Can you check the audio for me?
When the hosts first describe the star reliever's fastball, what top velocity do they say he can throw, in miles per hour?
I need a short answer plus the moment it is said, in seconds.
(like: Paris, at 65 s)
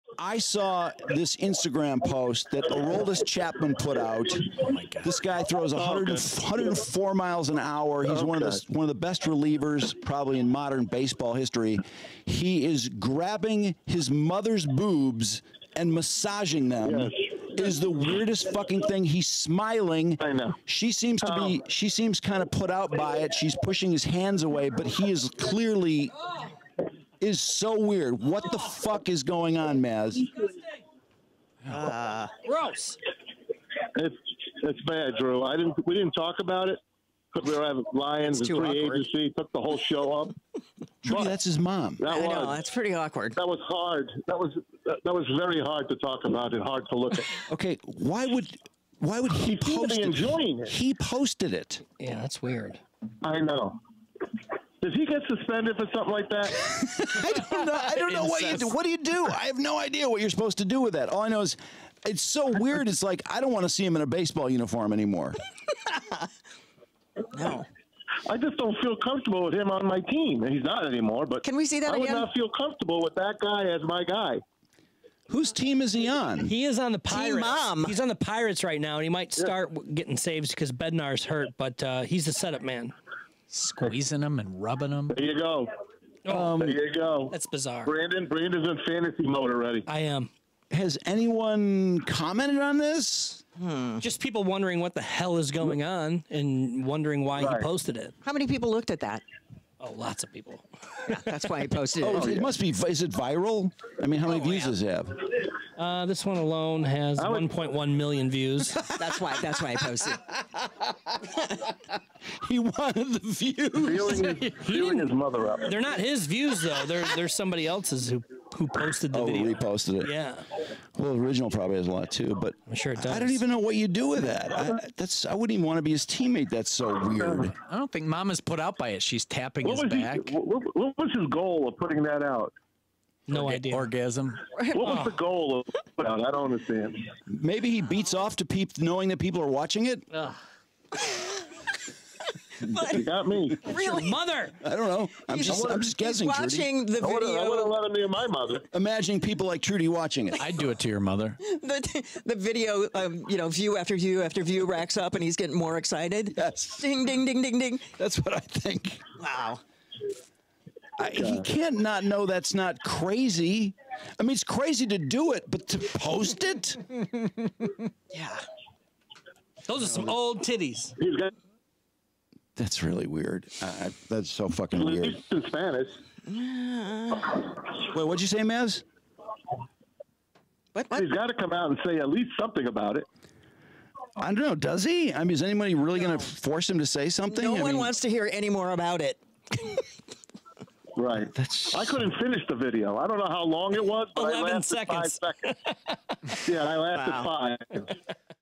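104, at 6 s.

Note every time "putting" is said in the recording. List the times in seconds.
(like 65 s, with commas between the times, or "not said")
131 s.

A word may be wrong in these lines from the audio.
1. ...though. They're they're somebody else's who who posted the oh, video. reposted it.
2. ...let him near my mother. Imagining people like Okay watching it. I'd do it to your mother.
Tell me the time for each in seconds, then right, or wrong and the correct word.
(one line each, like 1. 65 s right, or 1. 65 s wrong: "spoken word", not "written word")
1. 116 s right
2. 147 s wrong: "Trudy", not "Okay".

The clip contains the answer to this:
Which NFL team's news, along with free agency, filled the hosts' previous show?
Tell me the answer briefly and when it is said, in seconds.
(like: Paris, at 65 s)
Lions, at 37 s.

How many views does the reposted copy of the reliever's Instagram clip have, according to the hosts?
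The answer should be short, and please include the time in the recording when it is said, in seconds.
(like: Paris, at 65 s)
1.1 million, at 107 s.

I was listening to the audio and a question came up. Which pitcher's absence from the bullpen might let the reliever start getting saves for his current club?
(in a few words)
Bednar.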